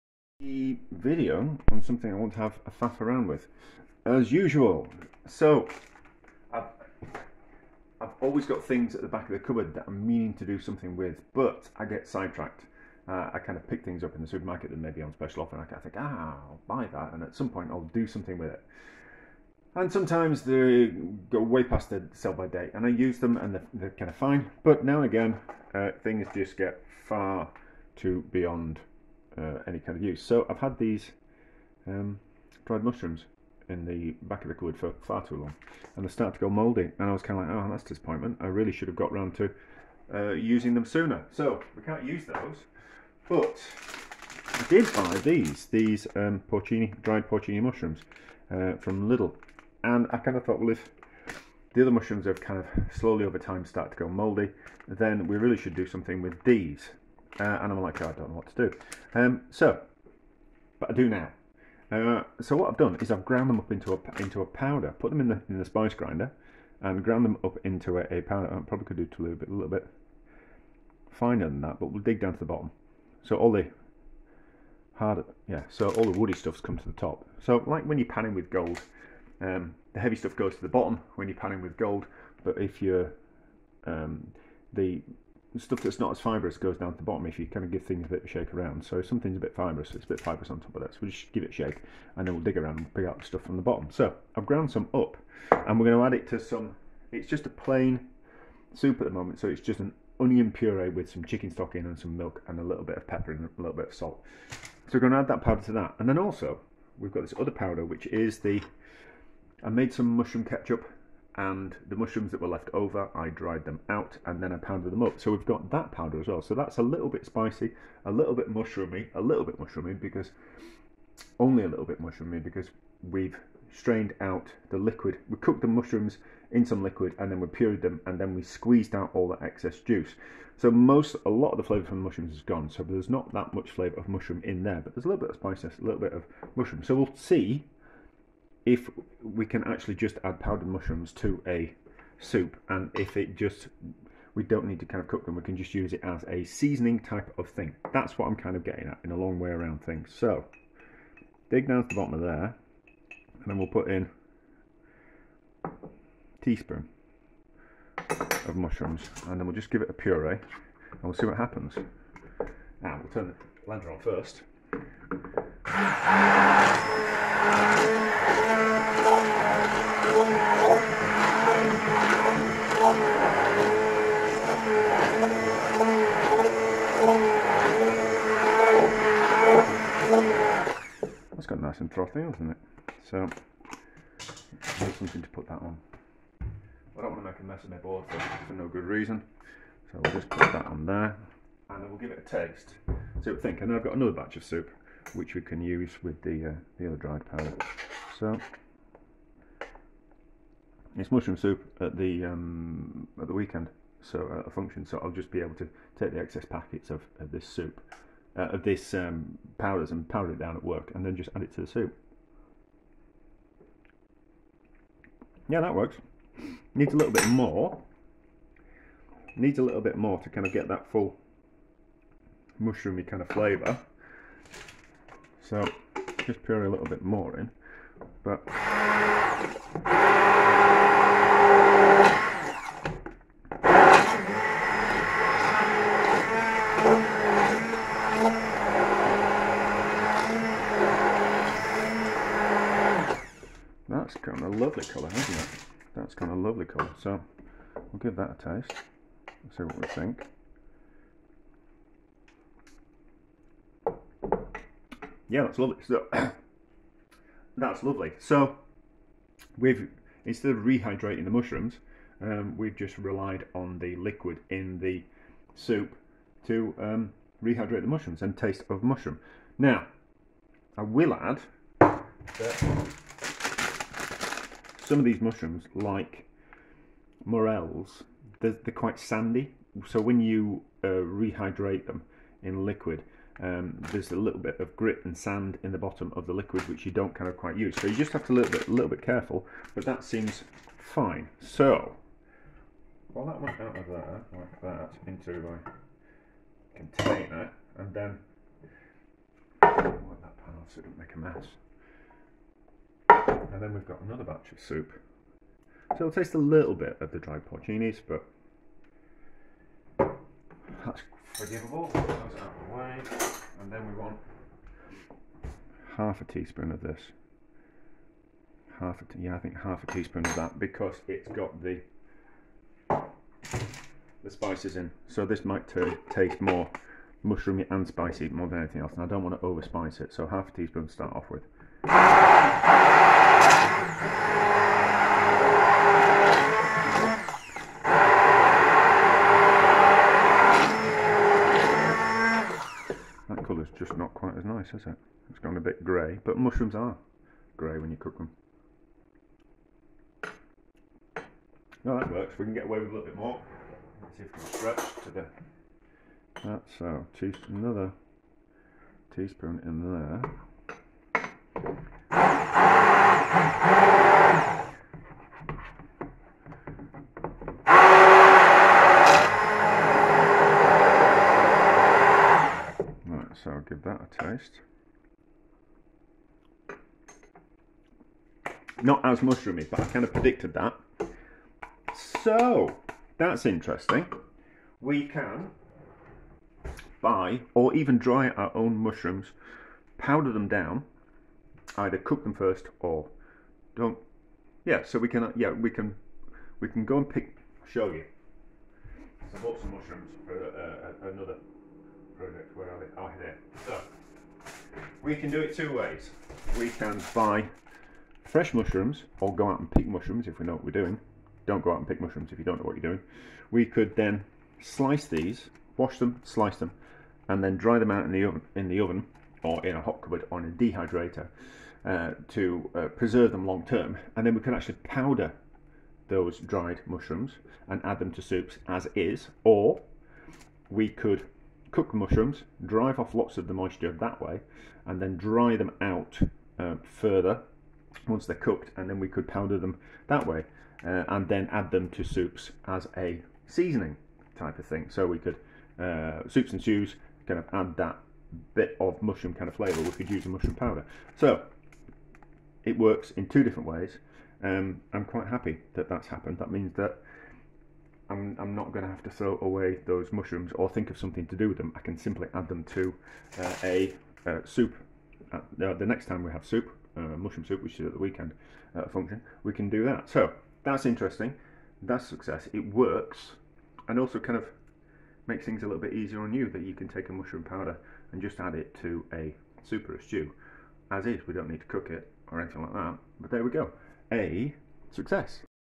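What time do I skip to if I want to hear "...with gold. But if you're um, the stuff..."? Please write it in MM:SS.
01:21.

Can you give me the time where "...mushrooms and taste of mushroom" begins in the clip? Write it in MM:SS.
04:27.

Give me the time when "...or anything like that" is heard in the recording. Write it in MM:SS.
08:02.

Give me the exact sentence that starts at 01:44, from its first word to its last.
So we're going to add that powder to that.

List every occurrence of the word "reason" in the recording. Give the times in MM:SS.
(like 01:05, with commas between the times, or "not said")
03:08.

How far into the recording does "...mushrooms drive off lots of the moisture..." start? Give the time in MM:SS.
07:11.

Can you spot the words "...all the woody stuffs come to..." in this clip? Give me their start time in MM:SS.
01:15.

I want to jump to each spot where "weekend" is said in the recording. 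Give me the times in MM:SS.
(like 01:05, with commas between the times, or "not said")
03:23, 07:47.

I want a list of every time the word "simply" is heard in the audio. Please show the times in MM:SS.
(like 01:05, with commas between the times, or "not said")
07:41.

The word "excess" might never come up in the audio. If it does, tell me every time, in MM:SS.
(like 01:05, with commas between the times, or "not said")
02:09, 03:26.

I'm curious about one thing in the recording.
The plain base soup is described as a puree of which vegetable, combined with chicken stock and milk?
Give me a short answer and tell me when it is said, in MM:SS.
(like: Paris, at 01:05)
onion, at 01:40.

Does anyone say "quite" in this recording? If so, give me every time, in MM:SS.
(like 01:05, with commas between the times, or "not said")
04:38, 04:47, 05:44, 07:35.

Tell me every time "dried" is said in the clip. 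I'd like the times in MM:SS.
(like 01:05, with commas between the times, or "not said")
00:32, 00:47, 01:53, 03:16, 05:07, 07:06.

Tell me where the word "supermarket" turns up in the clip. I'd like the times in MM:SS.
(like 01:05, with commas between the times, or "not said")
00:14.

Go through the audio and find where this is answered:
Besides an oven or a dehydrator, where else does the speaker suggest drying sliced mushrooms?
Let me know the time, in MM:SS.
06:59.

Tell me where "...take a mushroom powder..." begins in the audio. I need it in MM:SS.
07:56.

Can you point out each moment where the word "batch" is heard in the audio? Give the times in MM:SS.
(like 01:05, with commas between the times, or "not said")
03:14, 05:04.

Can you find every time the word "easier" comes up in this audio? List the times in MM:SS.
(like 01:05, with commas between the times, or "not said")
07:55.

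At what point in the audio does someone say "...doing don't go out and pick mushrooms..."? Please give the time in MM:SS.
06:50.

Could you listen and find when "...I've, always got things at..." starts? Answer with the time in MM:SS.
00:07.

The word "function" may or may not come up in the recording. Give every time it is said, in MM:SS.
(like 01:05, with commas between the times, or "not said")
03:24, 07:48.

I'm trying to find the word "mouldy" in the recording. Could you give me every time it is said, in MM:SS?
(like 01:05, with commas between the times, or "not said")
00:36, 00:54.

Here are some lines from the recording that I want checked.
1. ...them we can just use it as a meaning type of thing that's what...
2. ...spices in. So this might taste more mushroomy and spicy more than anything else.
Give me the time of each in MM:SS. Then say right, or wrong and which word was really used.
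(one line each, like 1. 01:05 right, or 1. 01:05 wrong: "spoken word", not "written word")
1. 02:25 wrong: "seasoning", not "meaning"
2. 05:24 right.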